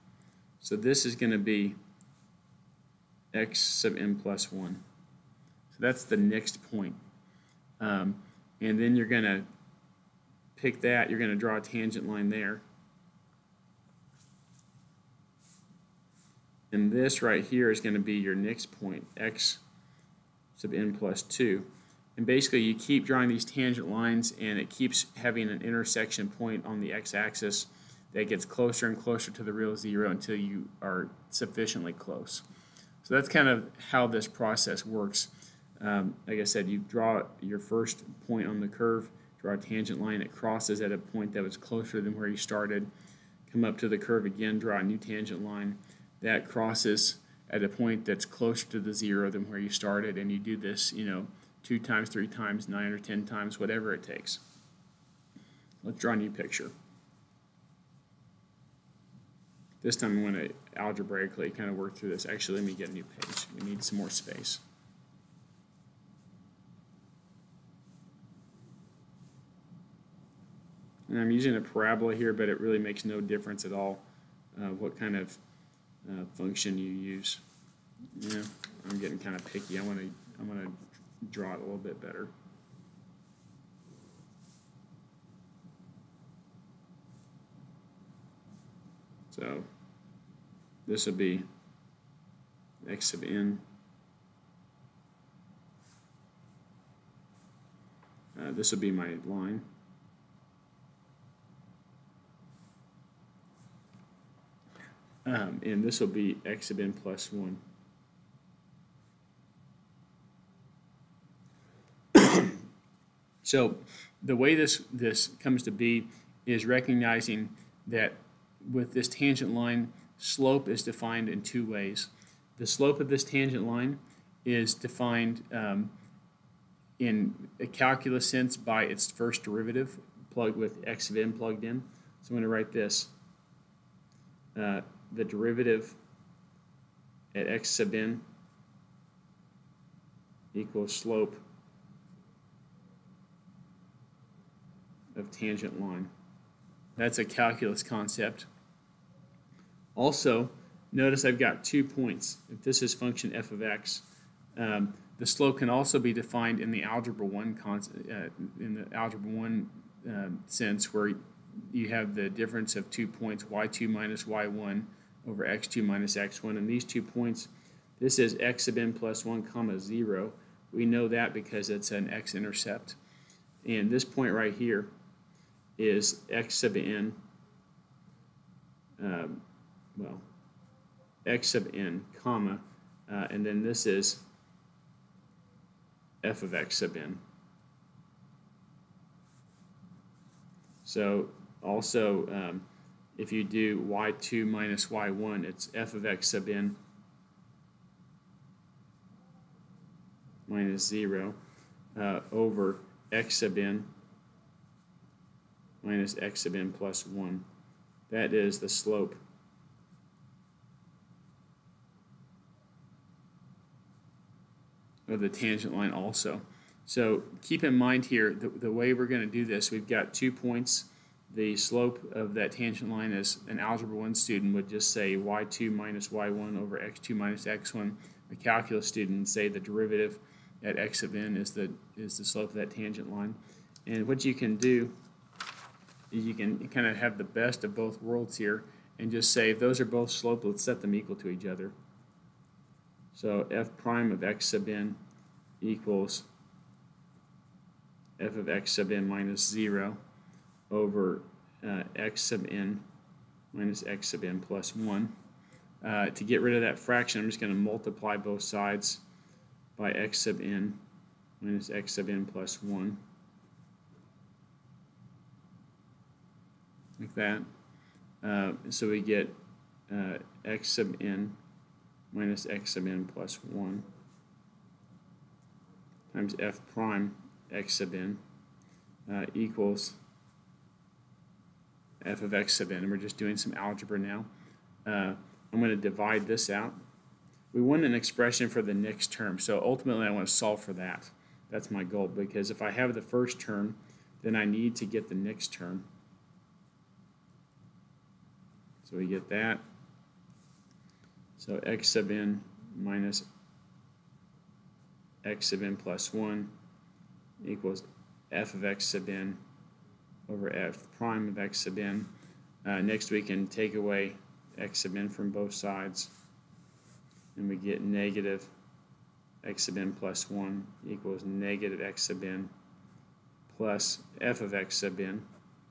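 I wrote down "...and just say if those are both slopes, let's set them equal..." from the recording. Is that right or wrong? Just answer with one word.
right.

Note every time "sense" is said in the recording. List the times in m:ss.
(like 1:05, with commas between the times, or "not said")
2:08, 2:40.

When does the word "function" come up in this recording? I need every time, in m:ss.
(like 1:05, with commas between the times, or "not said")
1:16, 2:32.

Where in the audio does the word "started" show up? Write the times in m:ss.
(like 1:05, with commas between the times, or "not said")
0:42, 0:49.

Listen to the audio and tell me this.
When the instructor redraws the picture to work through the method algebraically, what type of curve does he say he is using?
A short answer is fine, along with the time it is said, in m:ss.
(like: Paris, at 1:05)
Parabola, at 1:11.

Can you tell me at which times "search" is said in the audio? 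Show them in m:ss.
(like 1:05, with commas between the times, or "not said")
not said.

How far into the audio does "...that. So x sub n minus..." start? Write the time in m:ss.
4:59.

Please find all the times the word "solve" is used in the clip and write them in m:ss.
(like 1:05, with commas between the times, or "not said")
4:50.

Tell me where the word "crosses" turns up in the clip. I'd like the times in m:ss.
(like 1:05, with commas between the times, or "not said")
0:40, 0:46.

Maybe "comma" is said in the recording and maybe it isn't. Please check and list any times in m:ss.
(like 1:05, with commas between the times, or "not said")
2:49, 3:02.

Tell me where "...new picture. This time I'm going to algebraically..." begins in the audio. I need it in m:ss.
0:56.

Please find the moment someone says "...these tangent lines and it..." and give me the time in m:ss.
0:23.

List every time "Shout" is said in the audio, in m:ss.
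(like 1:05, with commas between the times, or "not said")
not said.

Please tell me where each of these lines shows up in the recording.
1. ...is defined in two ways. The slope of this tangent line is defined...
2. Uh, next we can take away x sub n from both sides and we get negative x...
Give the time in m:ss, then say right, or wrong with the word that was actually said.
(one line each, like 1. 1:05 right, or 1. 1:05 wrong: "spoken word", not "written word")
1. 2:00 right
2. 5:12 right.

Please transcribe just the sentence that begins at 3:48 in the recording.
A calculus student would say the derivative at x of n is the, is the slope of that tangent line.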